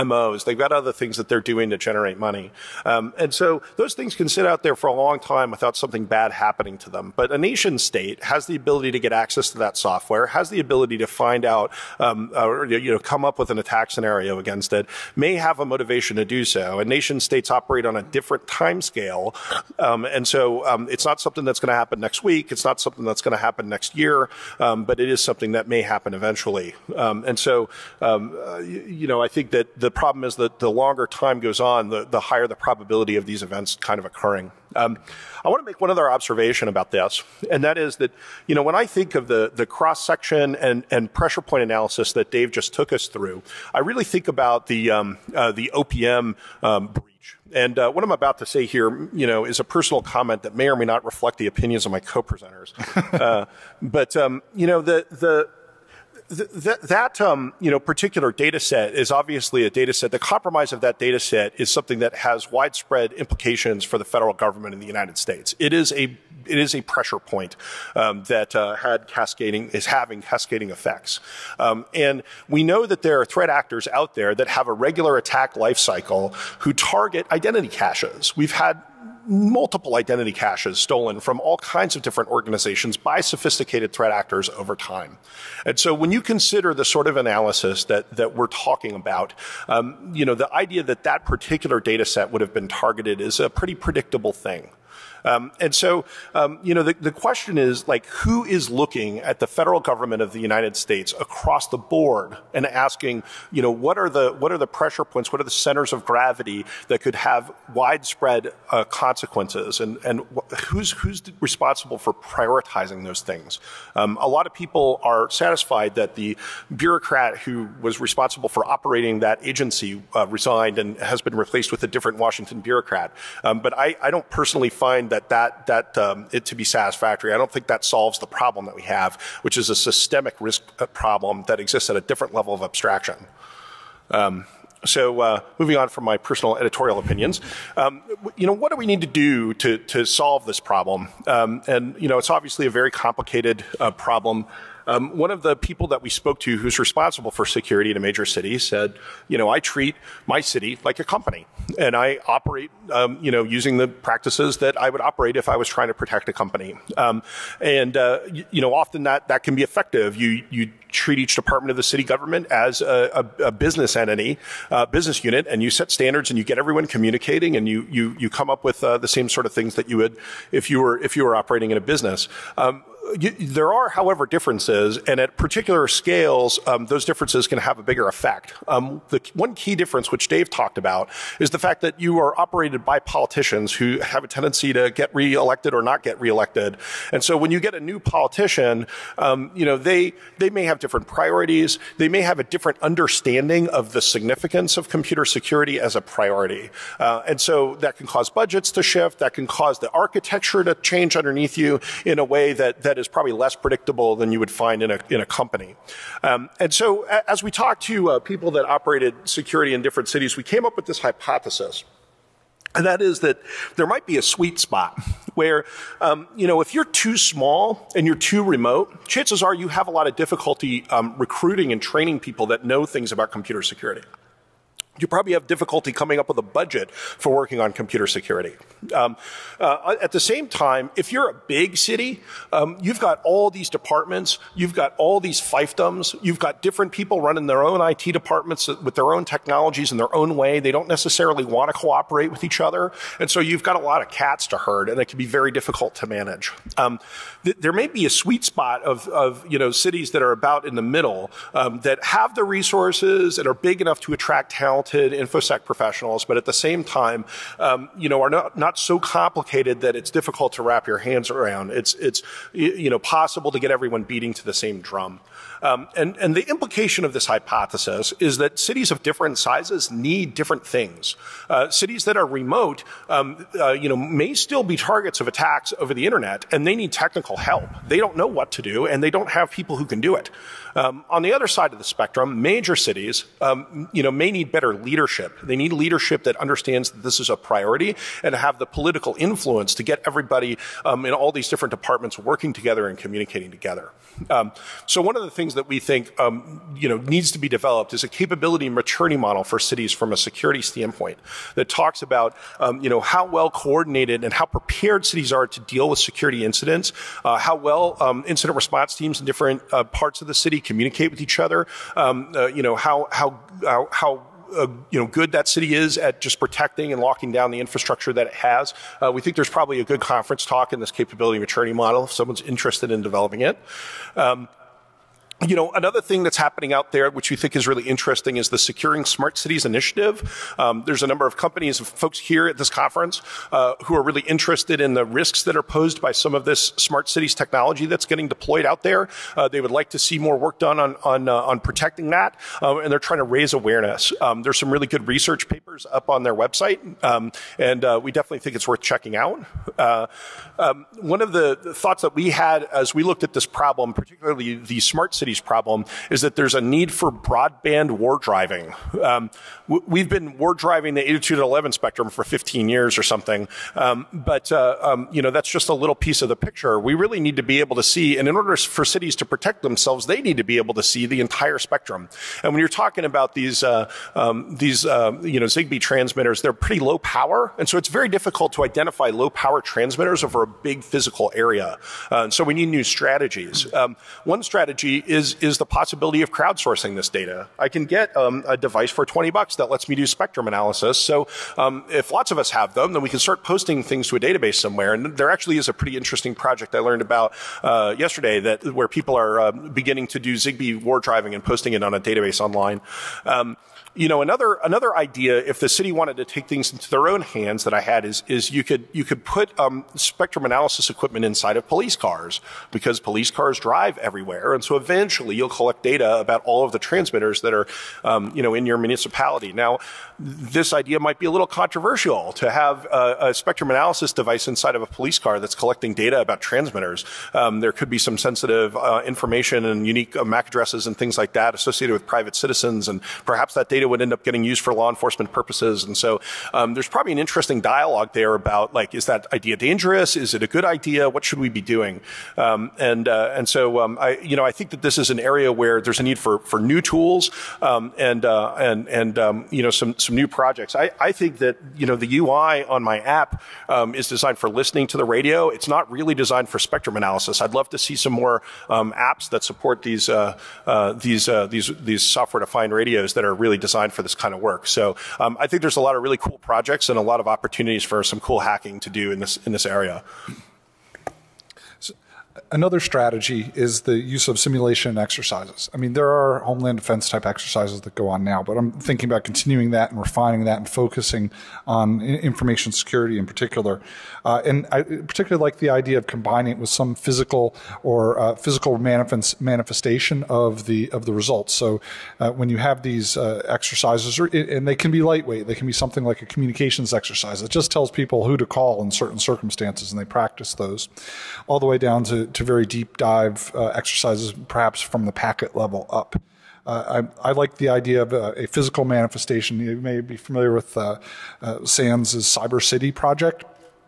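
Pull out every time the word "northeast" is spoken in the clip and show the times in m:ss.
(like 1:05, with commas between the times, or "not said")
not said.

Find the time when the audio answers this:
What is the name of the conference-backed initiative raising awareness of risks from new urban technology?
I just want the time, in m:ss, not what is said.
5:28.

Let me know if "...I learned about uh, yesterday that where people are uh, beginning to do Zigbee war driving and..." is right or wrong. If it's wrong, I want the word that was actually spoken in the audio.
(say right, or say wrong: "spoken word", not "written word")
right.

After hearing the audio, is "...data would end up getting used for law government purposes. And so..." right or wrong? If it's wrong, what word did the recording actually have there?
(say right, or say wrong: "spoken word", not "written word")
wrong: "enforcement", not "government".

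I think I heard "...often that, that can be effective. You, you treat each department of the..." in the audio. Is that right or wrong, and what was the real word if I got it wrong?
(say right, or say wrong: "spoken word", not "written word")
right.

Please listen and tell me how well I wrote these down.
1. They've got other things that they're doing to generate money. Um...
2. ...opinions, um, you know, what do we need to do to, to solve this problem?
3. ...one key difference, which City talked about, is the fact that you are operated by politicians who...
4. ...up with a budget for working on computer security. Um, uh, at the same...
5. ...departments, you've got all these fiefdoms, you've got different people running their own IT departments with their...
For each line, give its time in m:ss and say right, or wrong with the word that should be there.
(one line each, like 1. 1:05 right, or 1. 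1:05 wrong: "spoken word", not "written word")
1. 0:00 right
2. 2:16 right
3. 2:59 wrong: "Dave", not "City"
4. 3:46 right
5. 3:53 right.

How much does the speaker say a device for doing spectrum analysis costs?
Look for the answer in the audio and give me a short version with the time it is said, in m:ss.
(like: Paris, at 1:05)
$20, at 6:29.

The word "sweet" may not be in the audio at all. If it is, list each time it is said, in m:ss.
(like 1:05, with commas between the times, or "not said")
3:34, 4:08.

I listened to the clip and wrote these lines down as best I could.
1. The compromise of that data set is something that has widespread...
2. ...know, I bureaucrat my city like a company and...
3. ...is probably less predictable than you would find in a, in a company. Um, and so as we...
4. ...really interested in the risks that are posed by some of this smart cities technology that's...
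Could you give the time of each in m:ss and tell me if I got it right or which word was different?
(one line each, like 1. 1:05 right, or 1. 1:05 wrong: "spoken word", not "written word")
1. 1:00 right
2. 2:29 wrong: "treat", not "bureaucrat"
3. 3:23 right
4. 5:34 right.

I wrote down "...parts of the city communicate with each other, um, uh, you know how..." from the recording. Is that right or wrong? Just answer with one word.
right.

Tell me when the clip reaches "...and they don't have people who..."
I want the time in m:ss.
4:38.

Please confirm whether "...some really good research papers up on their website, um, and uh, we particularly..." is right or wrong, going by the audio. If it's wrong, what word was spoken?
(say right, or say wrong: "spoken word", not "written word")
wrong: "definitely", not "particularly".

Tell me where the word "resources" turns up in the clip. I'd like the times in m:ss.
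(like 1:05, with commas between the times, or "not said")
4:12.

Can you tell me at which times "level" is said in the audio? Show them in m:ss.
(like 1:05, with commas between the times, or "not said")
2:12, 8:25.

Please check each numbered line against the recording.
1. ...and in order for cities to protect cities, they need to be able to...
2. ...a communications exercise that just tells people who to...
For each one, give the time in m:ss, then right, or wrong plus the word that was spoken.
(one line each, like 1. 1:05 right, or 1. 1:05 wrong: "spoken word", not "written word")
1. 6:08 wrong: "themselves", not "cities"
2. 8:16 right.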